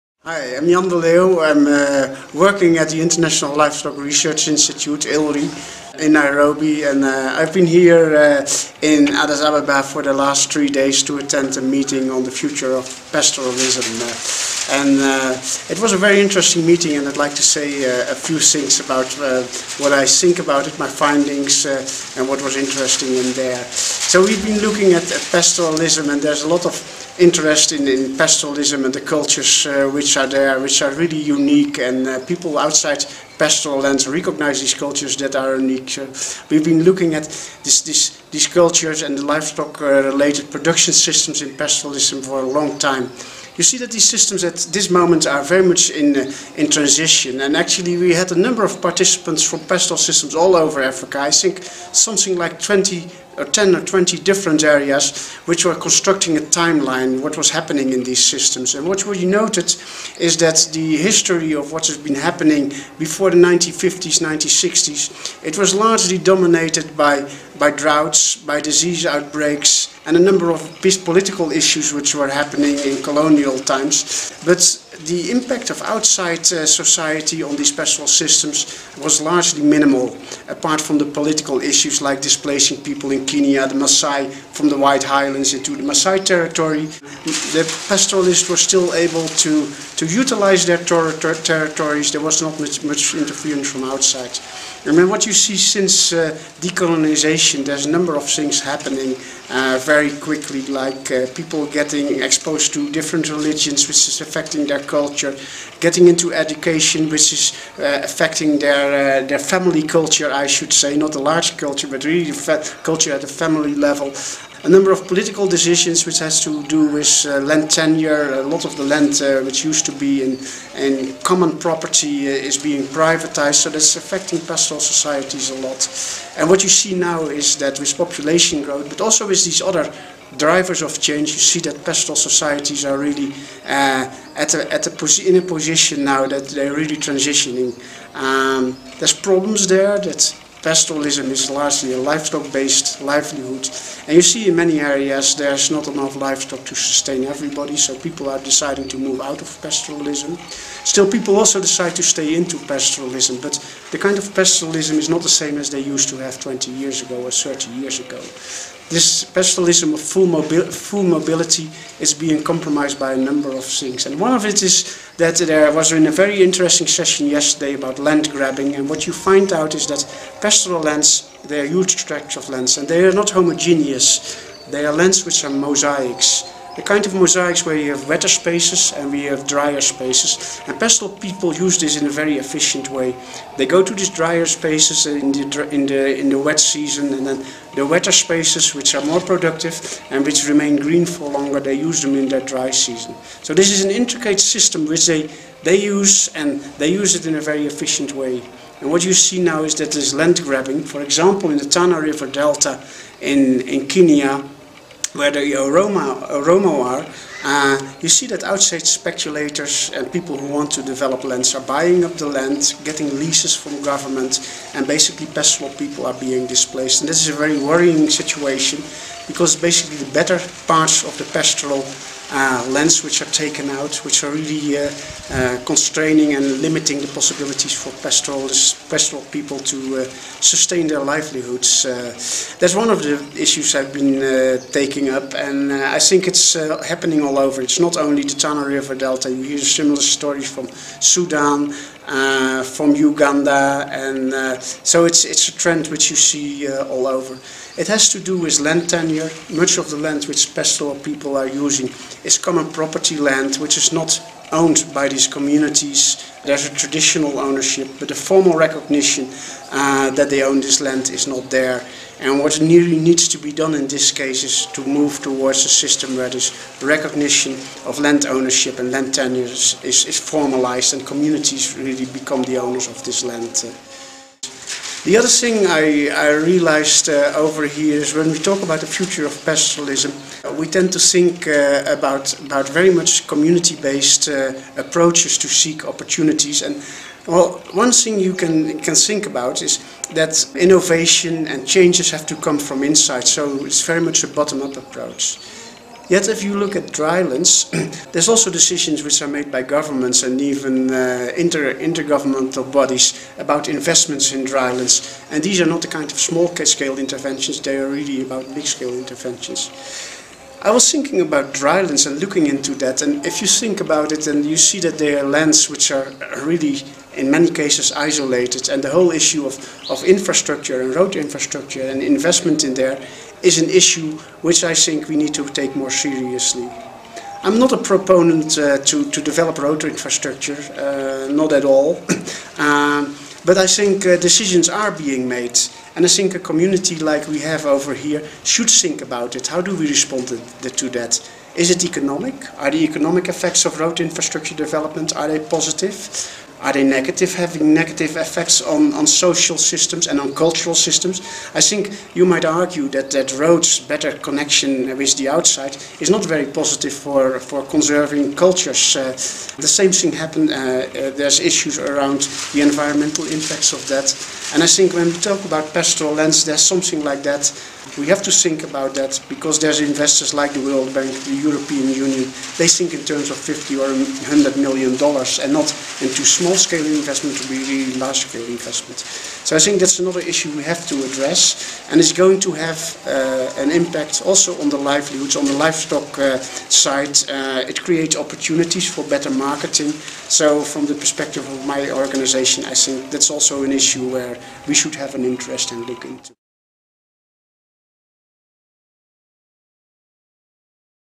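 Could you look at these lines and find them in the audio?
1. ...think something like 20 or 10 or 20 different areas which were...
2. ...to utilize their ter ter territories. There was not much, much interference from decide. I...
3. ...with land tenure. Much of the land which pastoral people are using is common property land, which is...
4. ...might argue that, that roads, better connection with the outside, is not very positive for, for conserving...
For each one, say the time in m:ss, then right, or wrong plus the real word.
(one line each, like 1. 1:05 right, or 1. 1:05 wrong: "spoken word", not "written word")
1. 0:51 right
2. 1:29 wrong: "outside", not "decide"
3. 4:08 right
4. 5:52 right.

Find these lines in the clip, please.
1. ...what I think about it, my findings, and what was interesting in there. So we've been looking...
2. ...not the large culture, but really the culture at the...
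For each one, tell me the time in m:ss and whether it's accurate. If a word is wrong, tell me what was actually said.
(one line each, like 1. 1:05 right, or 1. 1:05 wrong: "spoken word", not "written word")
1. 0:19 right
2. 1:50 right.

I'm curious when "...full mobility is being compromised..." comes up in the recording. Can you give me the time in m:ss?
2:40.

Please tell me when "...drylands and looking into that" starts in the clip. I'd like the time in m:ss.
5:11.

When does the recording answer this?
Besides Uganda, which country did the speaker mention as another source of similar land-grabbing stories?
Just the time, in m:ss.
4:01.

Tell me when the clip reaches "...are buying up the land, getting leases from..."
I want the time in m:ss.
3:31.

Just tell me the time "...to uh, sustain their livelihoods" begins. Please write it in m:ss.
3:49.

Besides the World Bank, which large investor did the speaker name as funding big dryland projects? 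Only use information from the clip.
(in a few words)
The European Union.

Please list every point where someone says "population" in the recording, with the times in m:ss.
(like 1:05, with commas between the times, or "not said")
2:07.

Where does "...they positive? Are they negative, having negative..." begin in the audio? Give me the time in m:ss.
5:45.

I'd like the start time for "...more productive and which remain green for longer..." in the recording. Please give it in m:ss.
3:09.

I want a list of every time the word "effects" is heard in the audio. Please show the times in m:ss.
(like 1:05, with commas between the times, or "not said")
5:43, 5:48.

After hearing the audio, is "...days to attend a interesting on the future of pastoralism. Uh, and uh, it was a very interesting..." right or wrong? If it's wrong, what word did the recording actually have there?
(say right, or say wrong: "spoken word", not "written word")
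wrong: "meeting", not "interesting".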